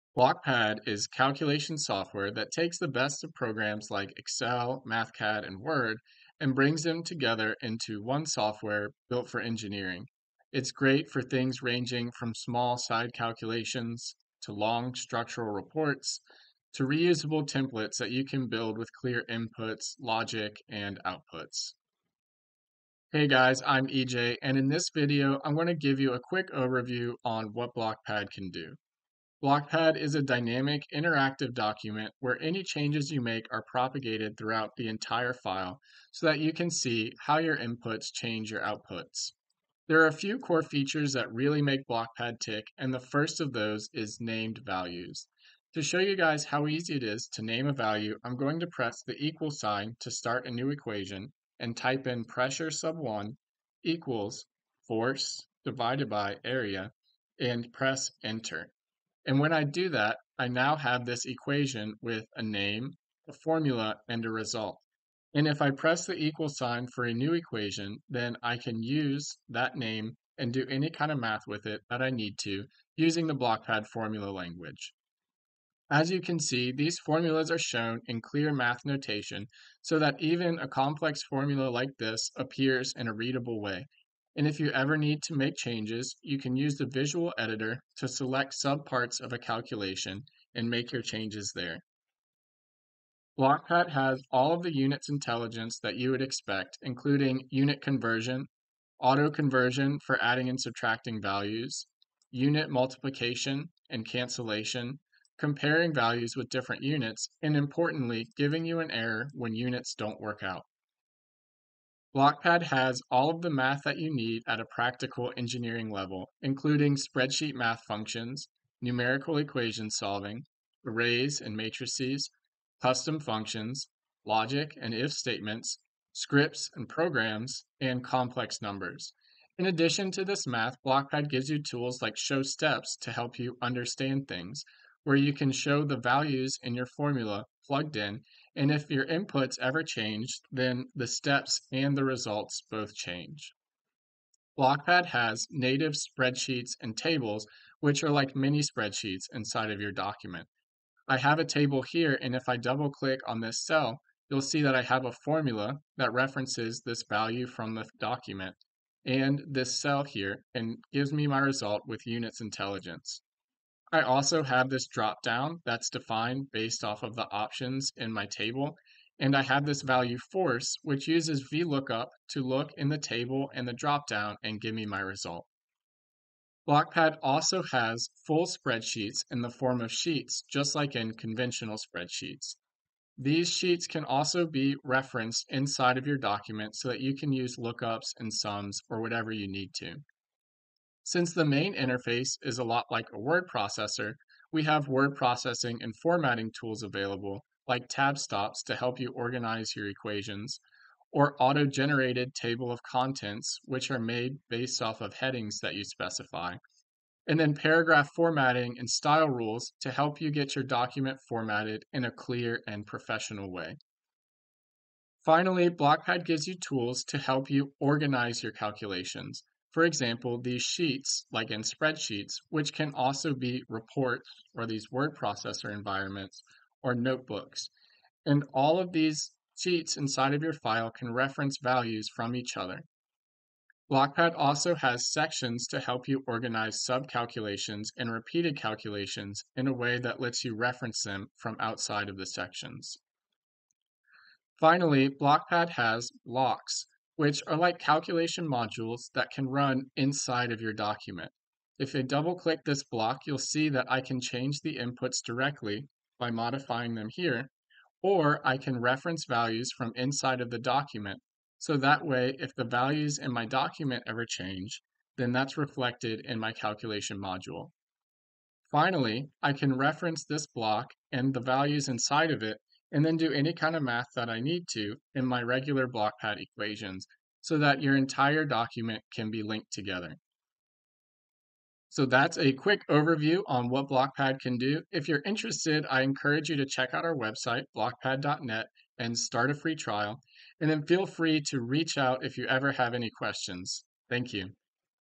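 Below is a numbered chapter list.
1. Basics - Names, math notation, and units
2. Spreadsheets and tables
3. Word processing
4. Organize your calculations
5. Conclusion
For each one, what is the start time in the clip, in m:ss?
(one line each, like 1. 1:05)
1. 0:29
2. 2:24
3. 3:10
4. 3:34
5. 4:42.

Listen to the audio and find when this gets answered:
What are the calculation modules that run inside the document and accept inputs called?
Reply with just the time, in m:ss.
4:06.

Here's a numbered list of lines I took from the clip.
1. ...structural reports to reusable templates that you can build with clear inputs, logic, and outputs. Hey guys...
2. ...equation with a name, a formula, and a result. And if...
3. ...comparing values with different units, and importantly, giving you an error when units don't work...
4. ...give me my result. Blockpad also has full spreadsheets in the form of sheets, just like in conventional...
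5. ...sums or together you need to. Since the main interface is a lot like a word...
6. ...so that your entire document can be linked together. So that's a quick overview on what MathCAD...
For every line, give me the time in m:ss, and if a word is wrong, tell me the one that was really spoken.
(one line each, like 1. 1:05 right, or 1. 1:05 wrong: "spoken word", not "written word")
1. 0:14 right
2. 1:01 right
3. 1:45 right
4. 2:54 right
5. 3:08 wrong: "whatever", not "together"
6. 4:37 wrong: "Blockpad", not "MathCAD".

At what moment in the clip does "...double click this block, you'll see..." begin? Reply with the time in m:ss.
4:12.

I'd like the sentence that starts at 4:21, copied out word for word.
So that way, if the values in my document ever change, then that's reflected in my calculation module.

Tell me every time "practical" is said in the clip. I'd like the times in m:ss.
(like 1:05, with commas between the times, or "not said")
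1:54.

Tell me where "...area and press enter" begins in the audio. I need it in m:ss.
0:56.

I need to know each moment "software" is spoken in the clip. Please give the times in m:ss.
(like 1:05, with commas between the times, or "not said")
0:01, 0:08.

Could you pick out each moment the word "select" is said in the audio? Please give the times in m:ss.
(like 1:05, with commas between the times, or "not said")
1:28.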